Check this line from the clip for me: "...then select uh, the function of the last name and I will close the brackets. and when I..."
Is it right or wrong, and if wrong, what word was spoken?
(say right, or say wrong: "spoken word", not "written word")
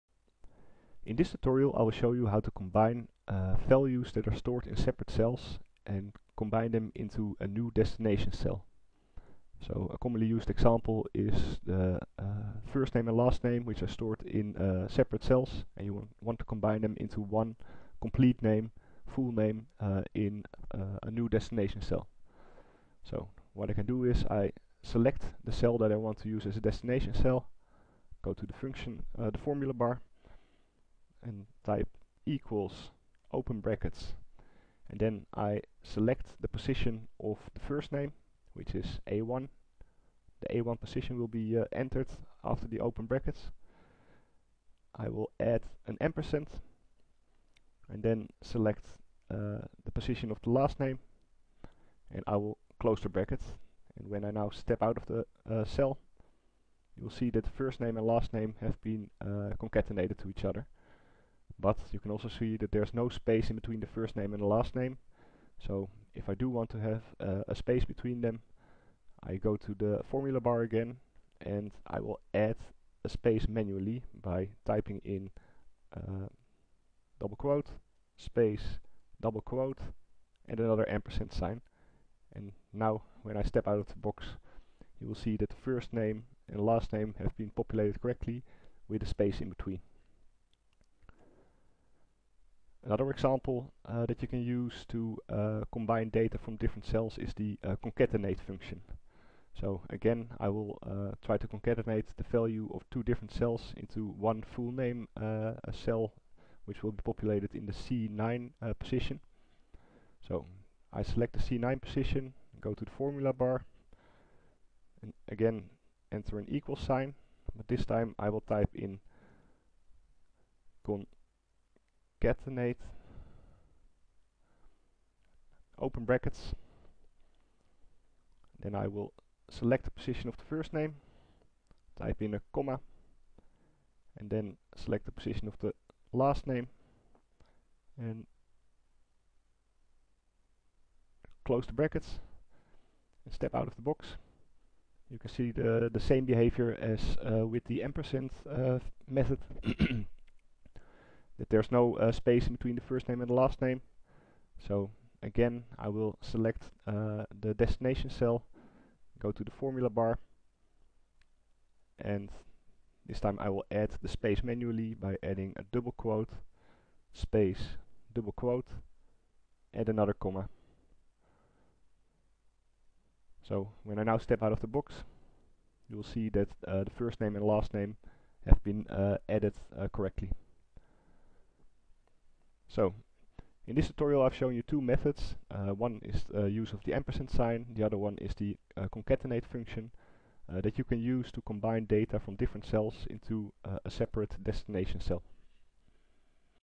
wrong: "position", not "function".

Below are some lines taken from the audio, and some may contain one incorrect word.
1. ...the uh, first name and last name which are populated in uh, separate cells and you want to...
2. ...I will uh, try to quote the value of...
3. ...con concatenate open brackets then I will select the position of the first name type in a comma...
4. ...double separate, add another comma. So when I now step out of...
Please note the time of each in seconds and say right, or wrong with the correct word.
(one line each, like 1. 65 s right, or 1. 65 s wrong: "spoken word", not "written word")
1. 11 s wrong: "stored", not "populated"
2. 100 s wrong: "concatenate", not "quote"
3. 120 s right
4. 168 s wrong: "quote", not "separate".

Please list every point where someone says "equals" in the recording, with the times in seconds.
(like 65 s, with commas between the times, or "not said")
32 s, 116 s.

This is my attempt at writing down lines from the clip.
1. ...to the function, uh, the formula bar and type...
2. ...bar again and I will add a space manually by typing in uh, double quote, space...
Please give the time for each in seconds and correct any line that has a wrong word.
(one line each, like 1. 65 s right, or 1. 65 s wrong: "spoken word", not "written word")
1. 28 s right
2. 70 s right.